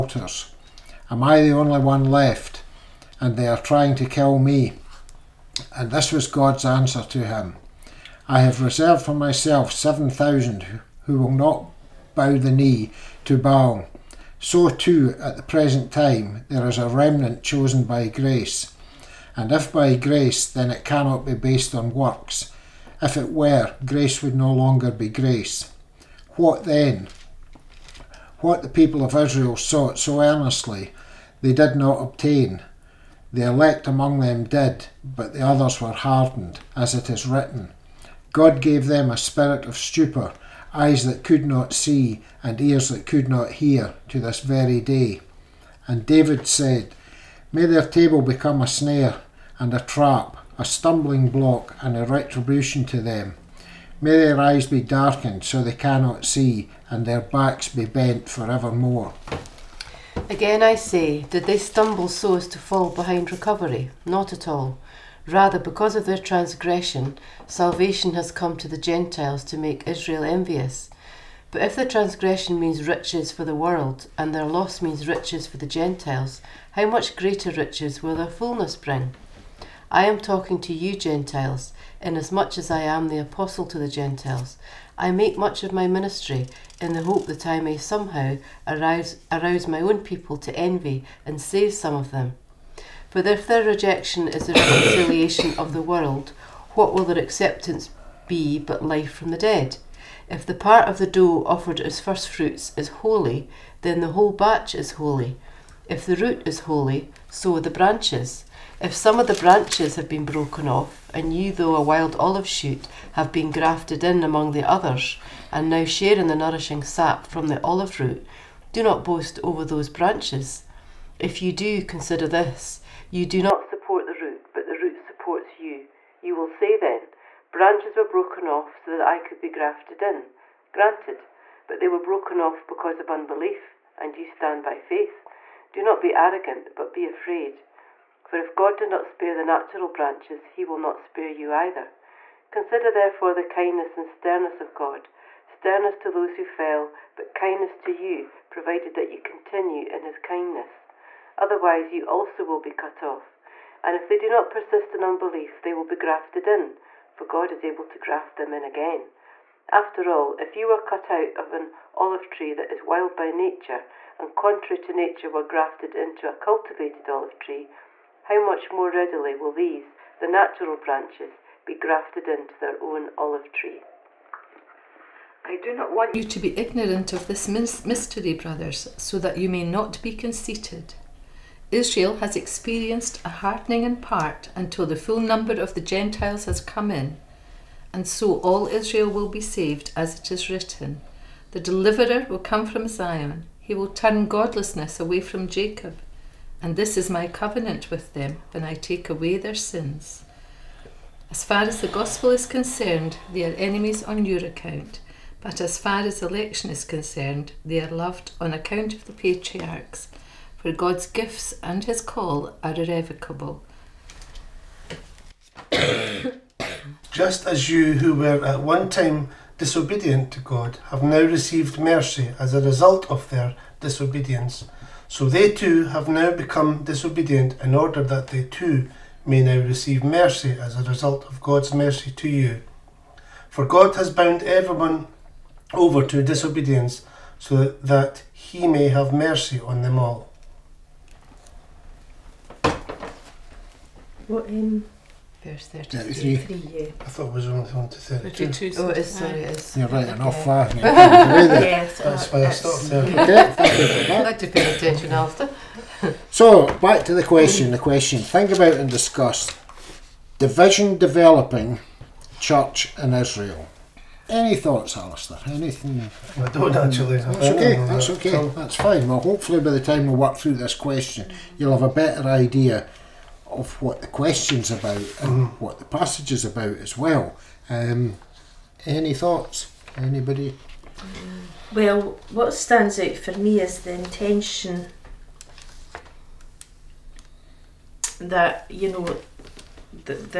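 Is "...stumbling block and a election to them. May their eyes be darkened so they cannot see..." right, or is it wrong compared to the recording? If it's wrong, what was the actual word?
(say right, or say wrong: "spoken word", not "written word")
wrong: "retribution", not "election".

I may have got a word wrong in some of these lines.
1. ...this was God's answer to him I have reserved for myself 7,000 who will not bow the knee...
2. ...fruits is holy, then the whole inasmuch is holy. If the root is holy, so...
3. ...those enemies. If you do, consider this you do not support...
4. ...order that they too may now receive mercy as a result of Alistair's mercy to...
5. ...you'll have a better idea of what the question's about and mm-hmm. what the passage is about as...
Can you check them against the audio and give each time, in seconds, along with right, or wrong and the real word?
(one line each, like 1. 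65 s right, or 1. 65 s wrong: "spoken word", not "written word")
1. 5 s right
2. 102 s wrong: "batch", not "inasmuch"
3. 119 s wrong: "branches", not "enemies"
4. 227 s wrong: "God", not "Alistair"
5. 271 s right.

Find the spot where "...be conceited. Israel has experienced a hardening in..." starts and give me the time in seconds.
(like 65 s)
180 s.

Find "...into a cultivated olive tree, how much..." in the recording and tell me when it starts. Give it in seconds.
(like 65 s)
165 s.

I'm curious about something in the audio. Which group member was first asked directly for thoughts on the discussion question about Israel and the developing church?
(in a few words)
Alistair.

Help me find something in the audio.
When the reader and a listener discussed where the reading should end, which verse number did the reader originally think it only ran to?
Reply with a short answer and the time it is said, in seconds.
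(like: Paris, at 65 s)
32, at 247 s.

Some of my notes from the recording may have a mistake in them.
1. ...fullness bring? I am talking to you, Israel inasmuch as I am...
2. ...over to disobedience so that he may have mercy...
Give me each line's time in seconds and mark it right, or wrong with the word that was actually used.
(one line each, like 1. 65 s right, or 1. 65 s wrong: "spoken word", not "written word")
1. 78 s wrong: "Gentiles", not "Israel"
2. 235 s right.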